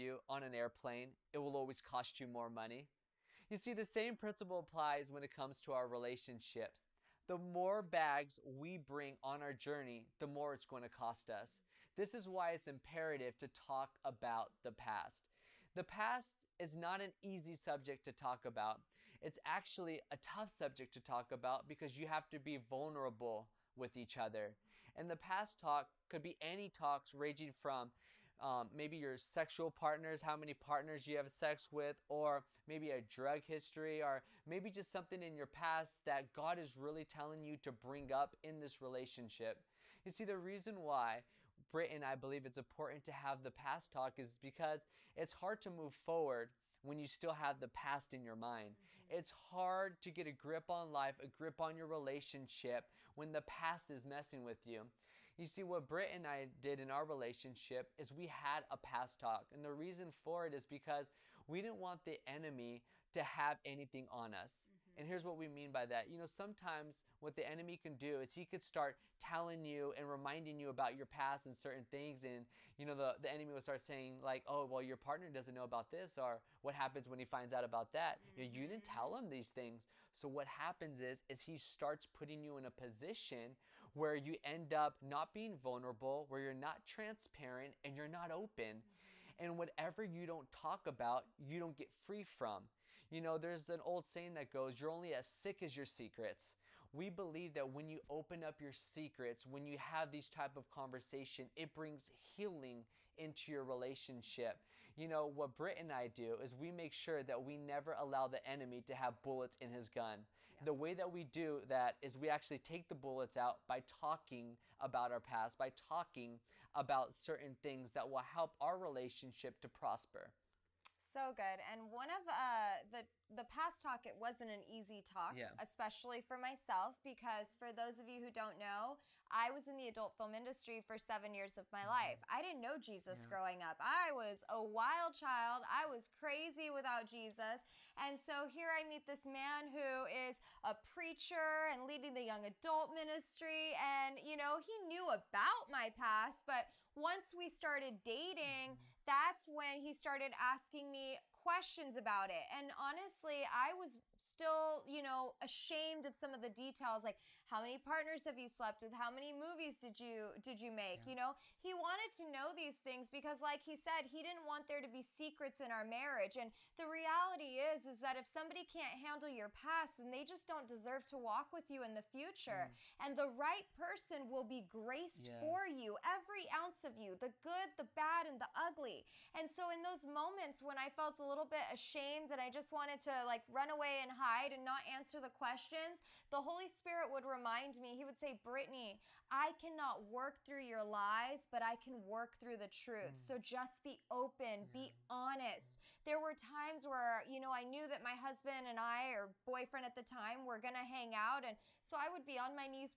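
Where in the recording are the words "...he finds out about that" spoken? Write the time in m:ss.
1:17.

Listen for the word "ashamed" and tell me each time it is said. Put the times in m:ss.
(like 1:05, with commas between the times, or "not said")
2:35, 3:01.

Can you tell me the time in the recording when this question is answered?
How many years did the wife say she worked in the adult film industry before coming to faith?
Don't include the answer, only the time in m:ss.
2:10.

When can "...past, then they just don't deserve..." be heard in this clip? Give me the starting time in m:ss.
2:49.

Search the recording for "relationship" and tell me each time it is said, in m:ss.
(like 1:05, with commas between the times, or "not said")
0:05, 0:38, 0:51, 0:57, 1:43, 1:58.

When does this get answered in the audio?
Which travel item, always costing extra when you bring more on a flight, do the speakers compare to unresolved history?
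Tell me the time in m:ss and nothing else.
0:07.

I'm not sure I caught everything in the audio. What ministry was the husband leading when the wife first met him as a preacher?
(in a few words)
young adult ministry.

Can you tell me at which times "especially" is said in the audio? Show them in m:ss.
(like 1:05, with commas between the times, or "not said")
2:05.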